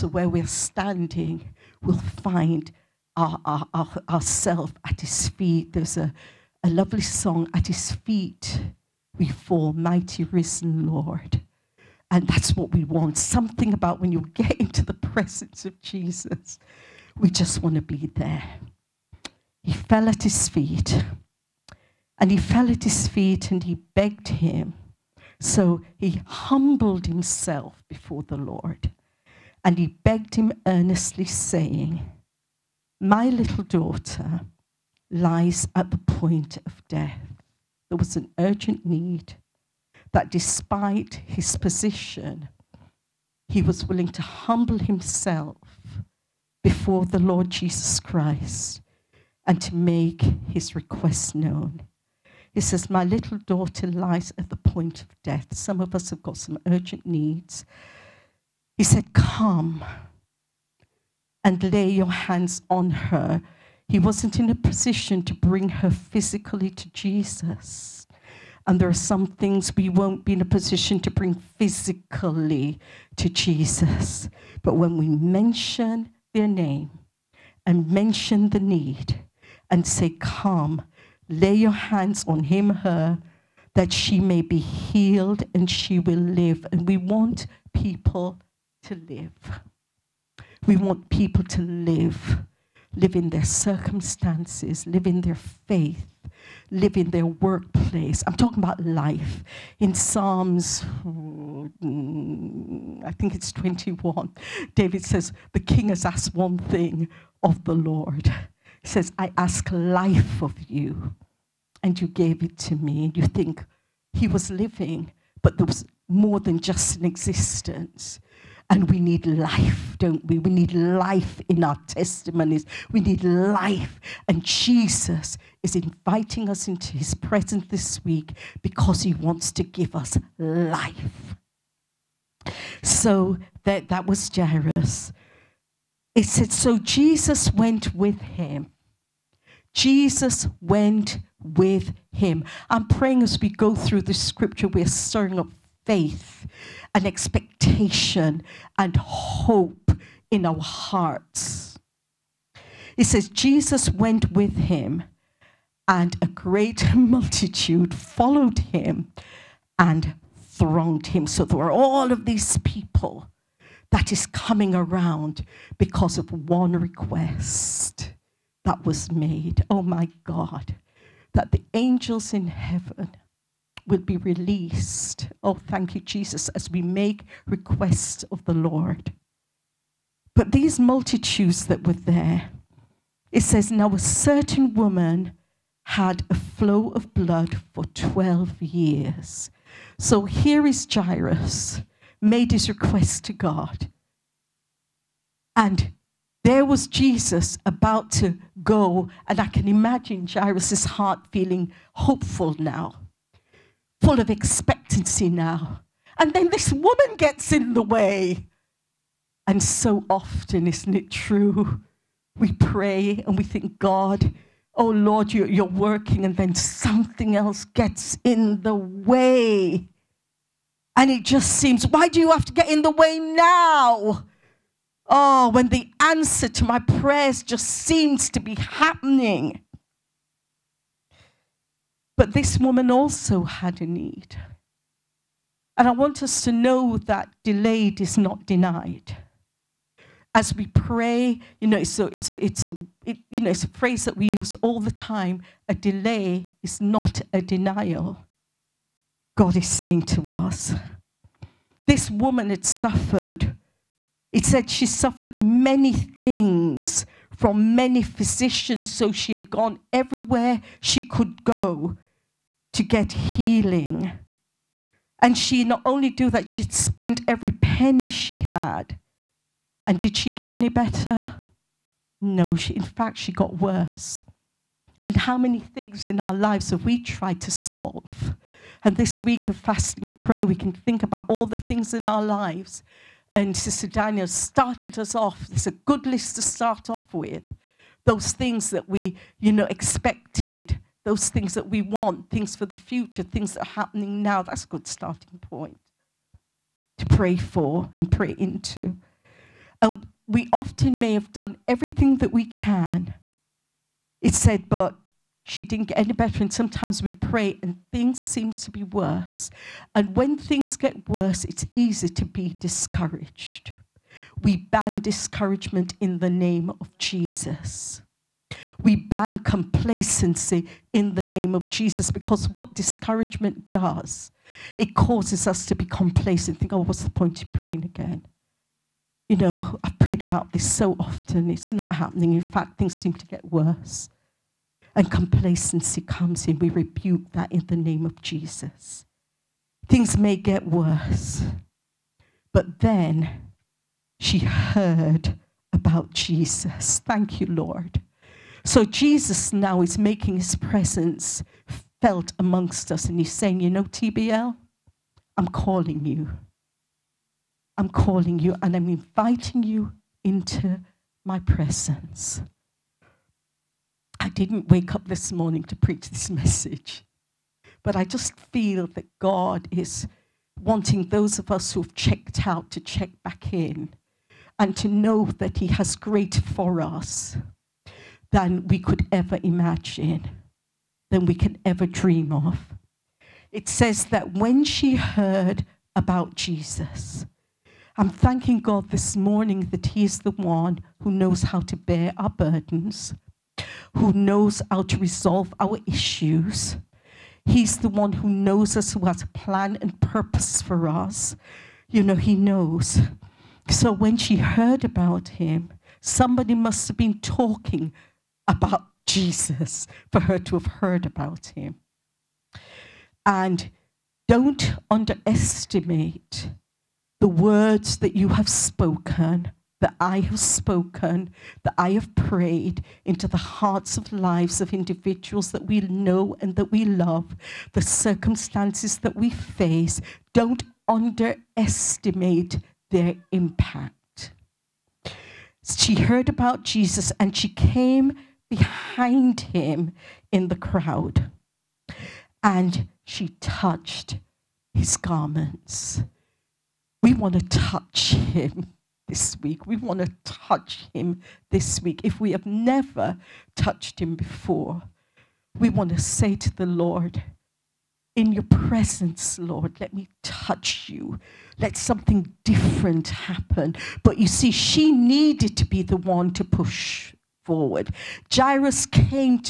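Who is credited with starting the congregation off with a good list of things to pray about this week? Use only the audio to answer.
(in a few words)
Sister Daniel.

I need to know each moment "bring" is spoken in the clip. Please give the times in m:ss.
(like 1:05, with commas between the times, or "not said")
1:05, 1:11.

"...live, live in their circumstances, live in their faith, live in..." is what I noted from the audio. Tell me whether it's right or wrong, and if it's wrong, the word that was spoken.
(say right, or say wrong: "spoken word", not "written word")
right.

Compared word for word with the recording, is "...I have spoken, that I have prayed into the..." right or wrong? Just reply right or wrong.
right.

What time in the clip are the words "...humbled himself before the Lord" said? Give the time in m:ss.
0:26.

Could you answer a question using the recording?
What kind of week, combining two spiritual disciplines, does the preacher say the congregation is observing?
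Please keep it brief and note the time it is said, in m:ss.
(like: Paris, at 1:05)
Fasting and prayer, at 4:39.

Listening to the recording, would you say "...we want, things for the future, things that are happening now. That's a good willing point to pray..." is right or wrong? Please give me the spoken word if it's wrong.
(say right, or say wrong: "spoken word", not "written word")
wrong: "starting", not "willing".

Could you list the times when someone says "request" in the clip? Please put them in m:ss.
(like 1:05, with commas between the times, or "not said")
0:50, 2:46, 2:57, 3:12.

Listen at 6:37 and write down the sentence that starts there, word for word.
He's the one who knows us, who has a plan and purpose for us.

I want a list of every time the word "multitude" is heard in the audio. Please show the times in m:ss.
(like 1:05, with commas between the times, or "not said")
2:36, 3:00.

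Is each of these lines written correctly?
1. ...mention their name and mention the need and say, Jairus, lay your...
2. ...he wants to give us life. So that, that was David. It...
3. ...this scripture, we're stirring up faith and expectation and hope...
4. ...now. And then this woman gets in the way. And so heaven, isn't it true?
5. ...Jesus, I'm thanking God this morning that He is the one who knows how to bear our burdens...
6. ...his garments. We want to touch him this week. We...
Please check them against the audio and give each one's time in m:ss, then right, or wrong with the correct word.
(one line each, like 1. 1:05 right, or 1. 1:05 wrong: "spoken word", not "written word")
1. 1:15 wrong: "Come", not "Jairus"
2. 2:09 wrong: "Jairus", not "David"
3. 2:24 right
4. 3:25 wrong: "often", not "heaven"
5. 6:26 right
6. 7:24 right.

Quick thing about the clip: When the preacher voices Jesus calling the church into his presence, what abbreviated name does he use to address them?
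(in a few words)
TBL.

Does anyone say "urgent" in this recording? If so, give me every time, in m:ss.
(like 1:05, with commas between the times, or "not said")
0:38, 0:56.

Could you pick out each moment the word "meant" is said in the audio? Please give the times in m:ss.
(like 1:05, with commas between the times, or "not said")
not said.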